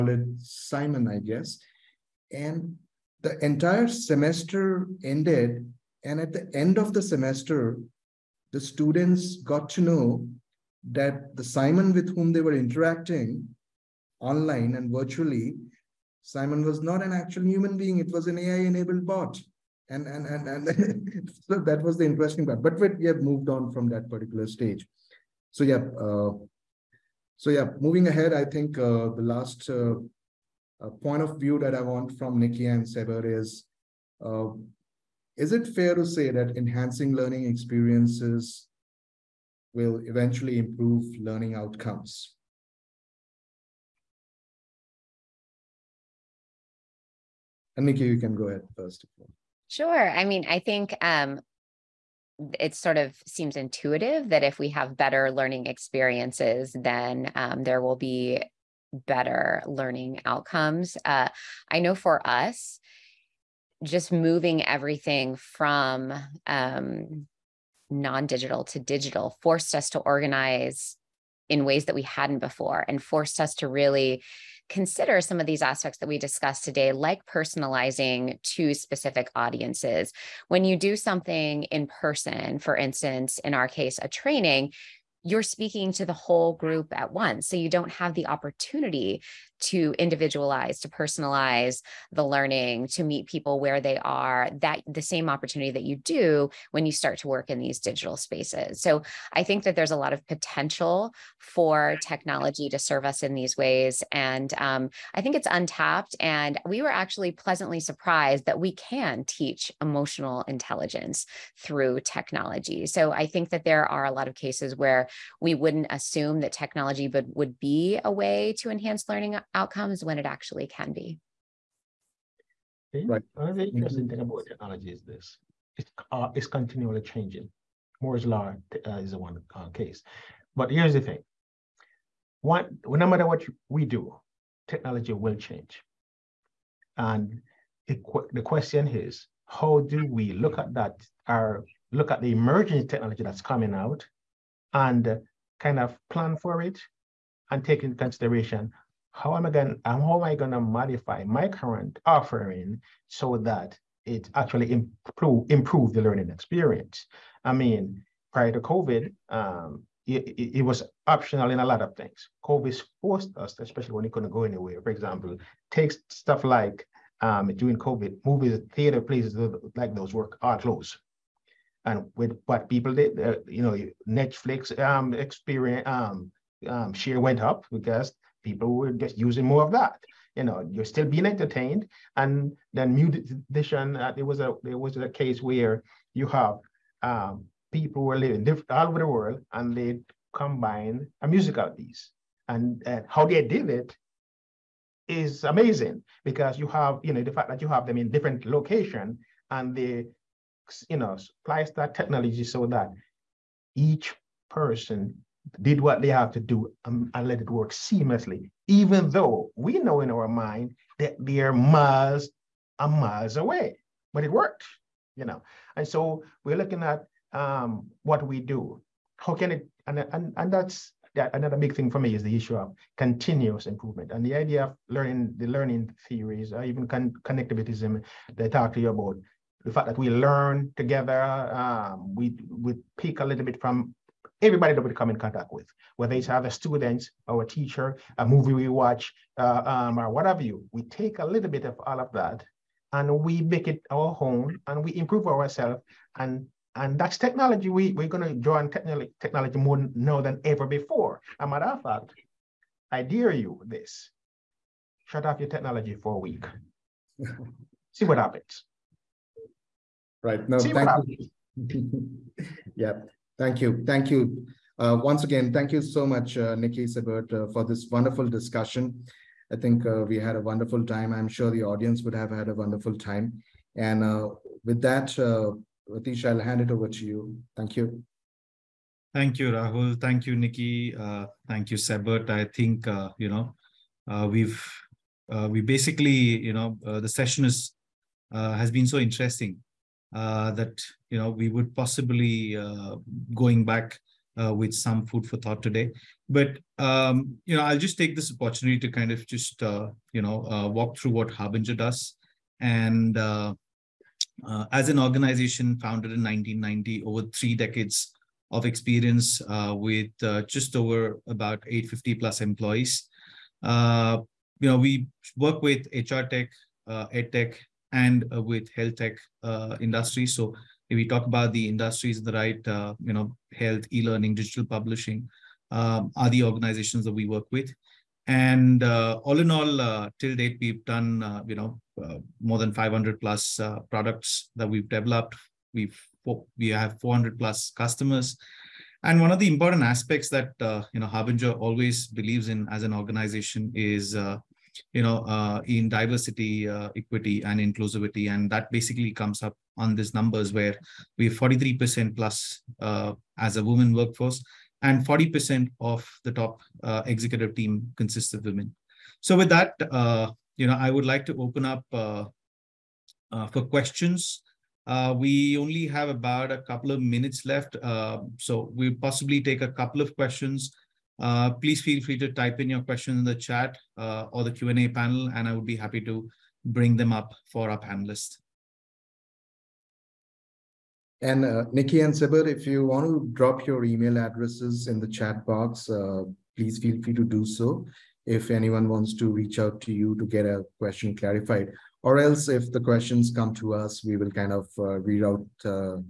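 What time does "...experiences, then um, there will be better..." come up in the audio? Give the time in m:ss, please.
0:55.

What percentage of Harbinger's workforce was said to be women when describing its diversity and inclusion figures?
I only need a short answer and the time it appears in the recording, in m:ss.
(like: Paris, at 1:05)
43%, at 5:51.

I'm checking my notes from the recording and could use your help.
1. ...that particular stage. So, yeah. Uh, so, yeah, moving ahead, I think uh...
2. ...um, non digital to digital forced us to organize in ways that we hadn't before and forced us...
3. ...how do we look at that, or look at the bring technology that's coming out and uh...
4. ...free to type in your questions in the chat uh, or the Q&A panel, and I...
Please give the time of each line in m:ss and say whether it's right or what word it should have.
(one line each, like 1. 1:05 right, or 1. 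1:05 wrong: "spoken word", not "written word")
1. 0:23 right
2. 1:06 right
3. 2:19 wrong: "emerging", not "bring"
4. 6:12 right.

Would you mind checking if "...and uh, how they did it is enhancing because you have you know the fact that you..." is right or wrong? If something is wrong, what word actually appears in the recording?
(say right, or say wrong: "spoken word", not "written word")
wrong: "amazing", not "enhancing".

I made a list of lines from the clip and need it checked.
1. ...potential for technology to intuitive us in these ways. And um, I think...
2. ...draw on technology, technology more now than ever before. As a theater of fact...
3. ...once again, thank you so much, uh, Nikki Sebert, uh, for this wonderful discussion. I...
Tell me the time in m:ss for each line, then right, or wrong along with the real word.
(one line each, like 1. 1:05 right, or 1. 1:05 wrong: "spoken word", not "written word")
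1. 1:40 wrong: "serve", not "intuitive"
2. 4:08 wrong: "matter", not "theater"
3. 4:25 right.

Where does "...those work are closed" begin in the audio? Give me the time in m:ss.
2:49.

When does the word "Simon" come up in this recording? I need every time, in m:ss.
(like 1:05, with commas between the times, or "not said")
0:00, 0:11, 0:16.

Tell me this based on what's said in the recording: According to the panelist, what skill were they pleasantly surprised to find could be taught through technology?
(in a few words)
Emotional intelligence.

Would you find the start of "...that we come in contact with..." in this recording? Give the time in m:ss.
3:54.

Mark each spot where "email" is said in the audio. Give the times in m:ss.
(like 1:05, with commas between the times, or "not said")
6:23.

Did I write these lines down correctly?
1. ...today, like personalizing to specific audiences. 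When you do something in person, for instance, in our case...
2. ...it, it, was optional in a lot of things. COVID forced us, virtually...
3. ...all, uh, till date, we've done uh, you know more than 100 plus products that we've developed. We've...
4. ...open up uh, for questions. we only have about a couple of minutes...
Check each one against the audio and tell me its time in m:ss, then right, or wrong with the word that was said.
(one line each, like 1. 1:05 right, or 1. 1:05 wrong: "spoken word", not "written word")
1. 1:16 right
2. 2:40 wrong: "especially", not "virtually"
3. 5:29 wrong: "500", not "100"
4. 6:01 right.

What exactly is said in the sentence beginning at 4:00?
We take a little bit of all of that and we make it our home, and we improve ourselves.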